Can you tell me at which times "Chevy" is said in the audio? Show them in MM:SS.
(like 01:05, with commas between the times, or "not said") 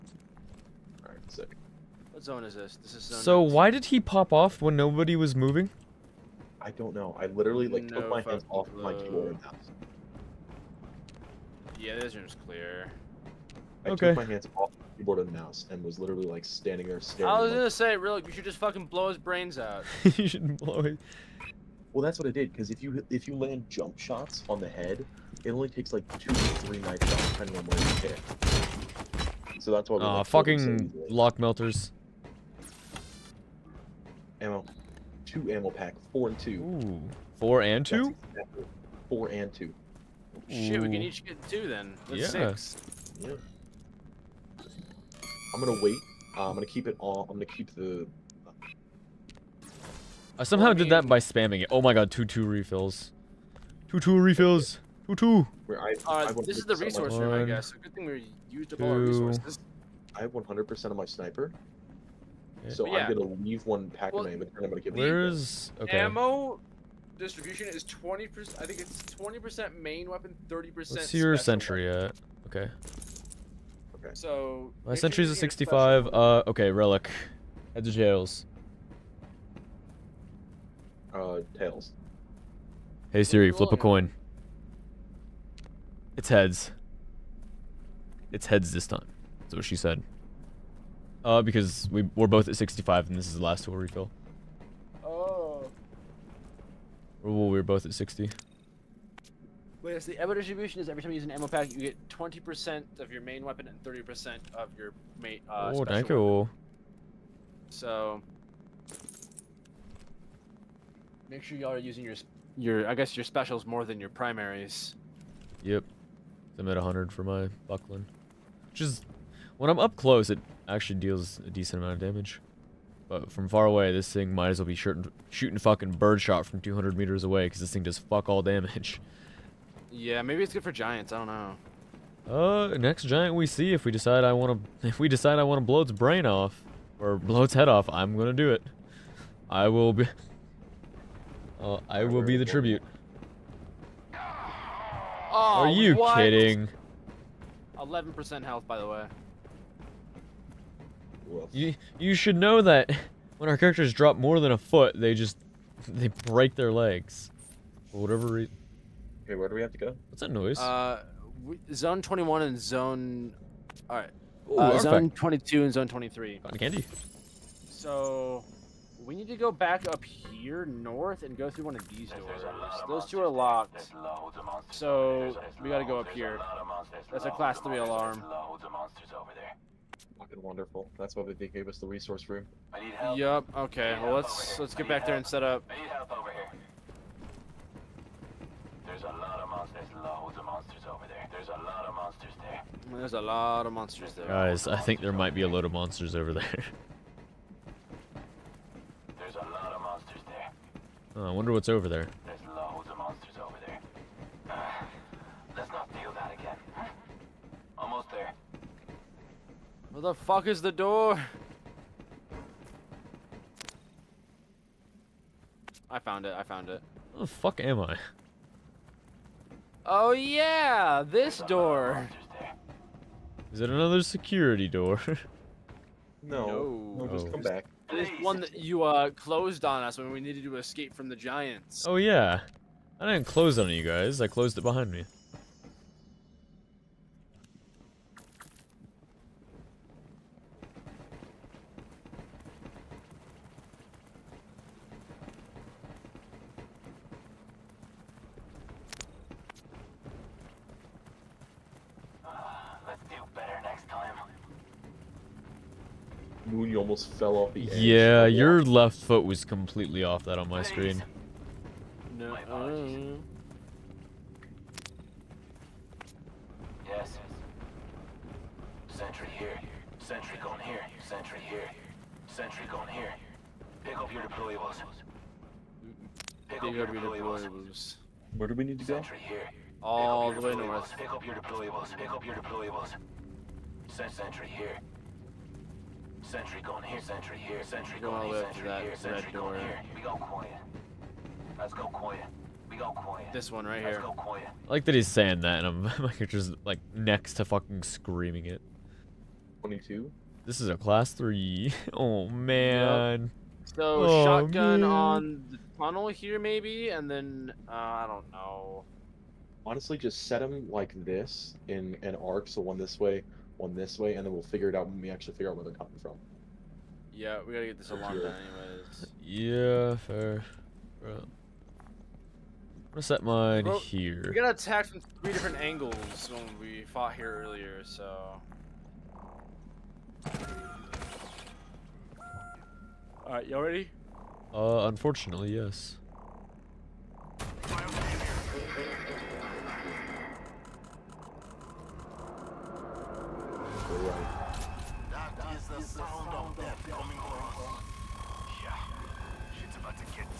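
not said.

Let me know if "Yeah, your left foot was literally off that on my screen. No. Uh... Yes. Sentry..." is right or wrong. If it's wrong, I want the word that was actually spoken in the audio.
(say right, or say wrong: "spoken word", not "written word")
wrong: "completely", not "literally".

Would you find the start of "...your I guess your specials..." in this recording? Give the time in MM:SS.
01:52.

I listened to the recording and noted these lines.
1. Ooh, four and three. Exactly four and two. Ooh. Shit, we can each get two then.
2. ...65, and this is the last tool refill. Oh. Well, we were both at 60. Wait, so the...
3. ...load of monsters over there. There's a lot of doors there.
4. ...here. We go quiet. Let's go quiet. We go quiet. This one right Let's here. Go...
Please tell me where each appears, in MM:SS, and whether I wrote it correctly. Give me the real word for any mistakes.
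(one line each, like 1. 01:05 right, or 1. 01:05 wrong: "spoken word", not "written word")
1. 00:36 wrong: "two", not "three"
2. 01:32 right
3. 03:15 wrong: "monsters", not "doors"
4. 04:49 right.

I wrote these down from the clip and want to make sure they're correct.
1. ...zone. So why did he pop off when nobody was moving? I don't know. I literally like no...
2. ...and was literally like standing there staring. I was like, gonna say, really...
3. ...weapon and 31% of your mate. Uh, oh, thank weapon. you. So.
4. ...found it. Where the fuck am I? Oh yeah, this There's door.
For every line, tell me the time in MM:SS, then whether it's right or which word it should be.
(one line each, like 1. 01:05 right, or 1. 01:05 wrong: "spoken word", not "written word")
1. 00:03 right
2. 00:15 right
3. 01:43 wrong: "30", not "31"
4. 03:36 right.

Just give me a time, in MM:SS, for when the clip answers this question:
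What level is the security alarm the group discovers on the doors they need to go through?
02:57.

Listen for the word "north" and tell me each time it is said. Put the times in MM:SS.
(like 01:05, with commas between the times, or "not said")
02:50, 04:40.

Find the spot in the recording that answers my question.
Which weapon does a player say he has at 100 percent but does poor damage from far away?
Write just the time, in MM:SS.
01:57.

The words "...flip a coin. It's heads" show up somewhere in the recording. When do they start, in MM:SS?
01:23.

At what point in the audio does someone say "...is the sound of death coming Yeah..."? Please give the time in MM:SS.
05:45.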